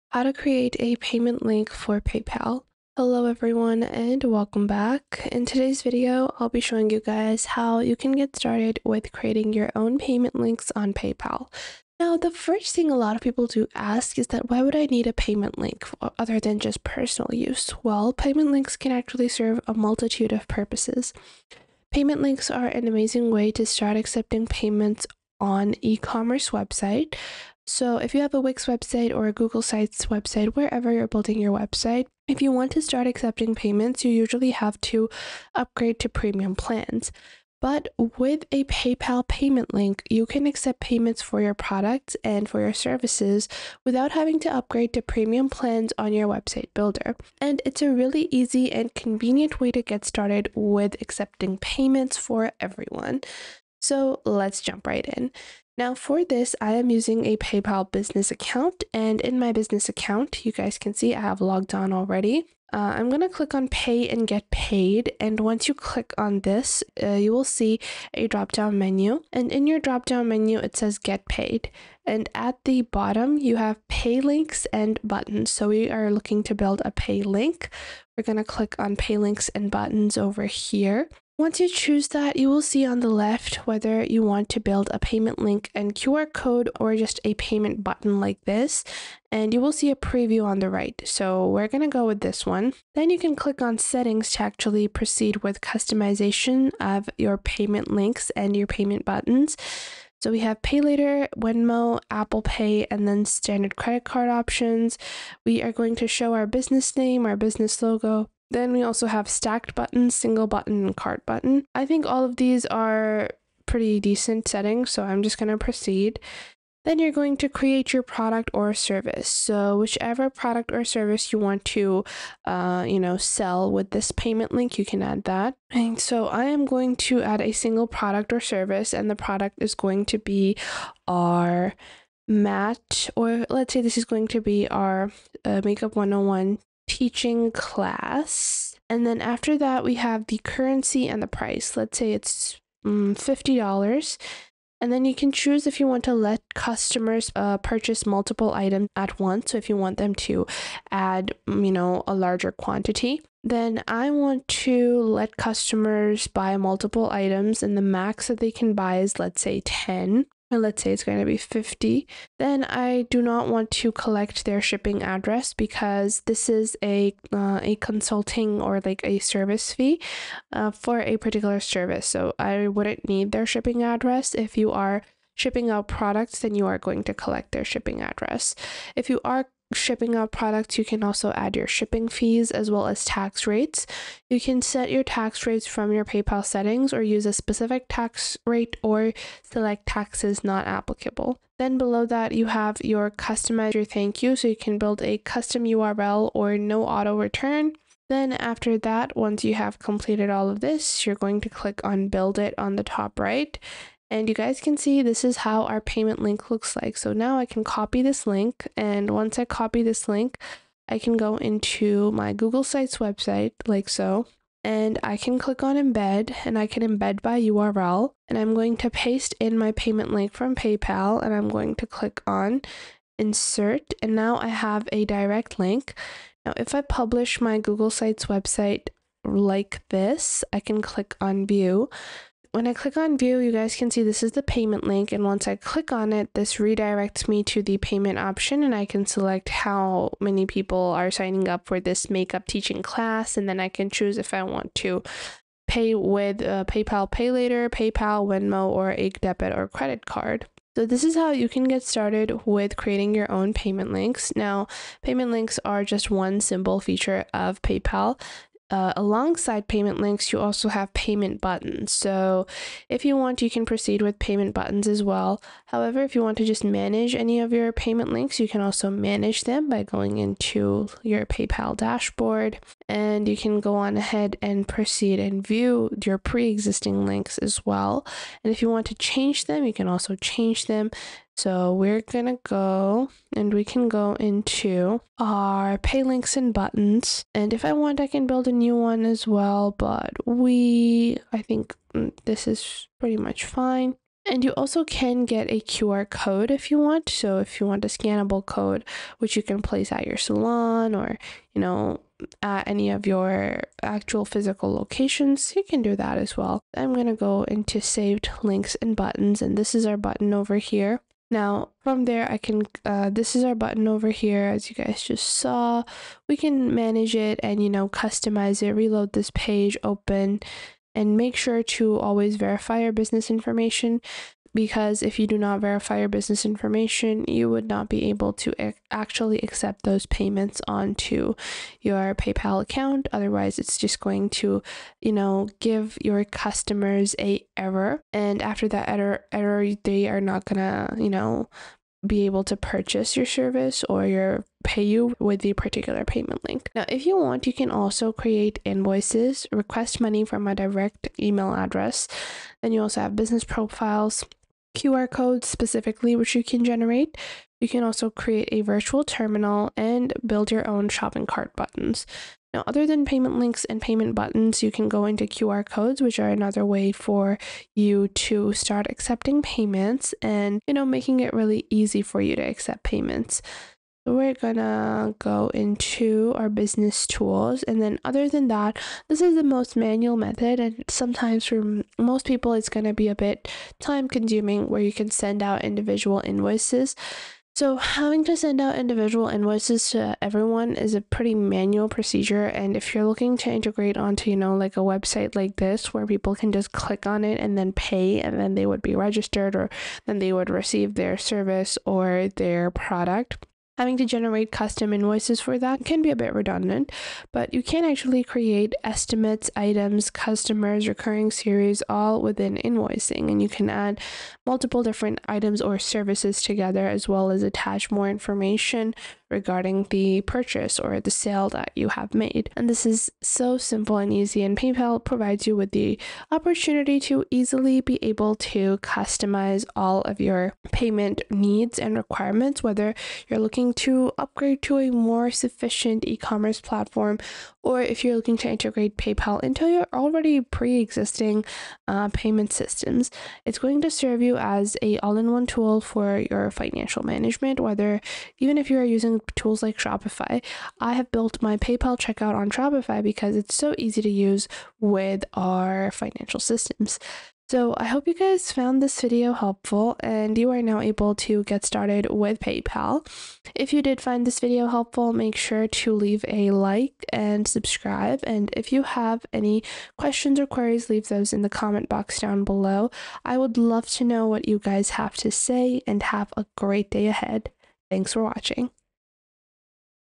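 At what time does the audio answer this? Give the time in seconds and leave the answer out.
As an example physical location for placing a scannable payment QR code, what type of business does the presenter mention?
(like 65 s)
300 s.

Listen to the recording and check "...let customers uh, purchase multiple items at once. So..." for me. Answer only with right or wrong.
right.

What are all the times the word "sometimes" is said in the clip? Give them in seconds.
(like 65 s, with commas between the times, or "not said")
380 s.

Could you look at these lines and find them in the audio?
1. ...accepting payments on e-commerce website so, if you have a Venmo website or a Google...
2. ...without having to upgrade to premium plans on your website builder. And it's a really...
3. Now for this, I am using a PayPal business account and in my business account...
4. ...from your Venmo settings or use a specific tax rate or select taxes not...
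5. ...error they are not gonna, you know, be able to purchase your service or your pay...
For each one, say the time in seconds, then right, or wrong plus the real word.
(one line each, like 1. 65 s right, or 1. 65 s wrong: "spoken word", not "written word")
1. 23 s wrong: "Wix", not "Venmo"
2. 43 s right
3. 55 s right
4. 185 s wrong: "PayPal", not "Venmo"
5. 339 s right.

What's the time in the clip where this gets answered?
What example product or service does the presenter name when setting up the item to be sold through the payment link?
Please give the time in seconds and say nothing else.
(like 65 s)
135 s.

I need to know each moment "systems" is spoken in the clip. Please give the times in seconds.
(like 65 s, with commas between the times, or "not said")
442 s, 456 s.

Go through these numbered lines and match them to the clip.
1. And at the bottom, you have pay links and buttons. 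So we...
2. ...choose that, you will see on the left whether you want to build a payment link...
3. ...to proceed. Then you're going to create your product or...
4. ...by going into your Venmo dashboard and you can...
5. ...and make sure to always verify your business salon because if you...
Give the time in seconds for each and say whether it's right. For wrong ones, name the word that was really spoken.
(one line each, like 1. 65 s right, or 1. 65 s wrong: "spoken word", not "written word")
1. 72 s right
2. 81 s right
3. 115 s right
4. 269 s wrong: "PayPal", not "Venmo"
5. 320 s wrong: "information", not "salon".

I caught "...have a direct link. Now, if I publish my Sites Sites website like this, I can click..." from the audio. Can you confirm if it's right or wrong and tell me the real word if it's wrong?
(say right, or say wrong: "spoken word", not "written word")
wrong: "Google", not "Sites".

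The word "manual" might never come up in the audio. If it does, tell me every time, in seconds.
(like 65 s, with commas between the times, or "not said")
379 s, 391 s.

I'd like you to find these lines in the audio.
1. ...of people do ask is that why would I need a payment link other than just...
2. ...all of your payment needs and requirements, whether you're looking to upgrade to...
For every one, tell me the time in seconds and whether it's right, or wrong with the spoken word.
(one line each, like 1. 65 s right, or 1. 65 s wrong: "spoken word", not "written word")
1. 13 s right
2. 429 s right.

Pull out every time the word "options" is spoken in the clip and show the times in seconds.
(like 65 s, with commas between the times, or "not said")
104 s, 238 s.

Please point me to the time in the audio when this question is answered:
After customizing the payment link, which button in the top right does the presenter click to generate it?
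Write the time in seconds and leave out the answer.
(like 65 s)
202 s.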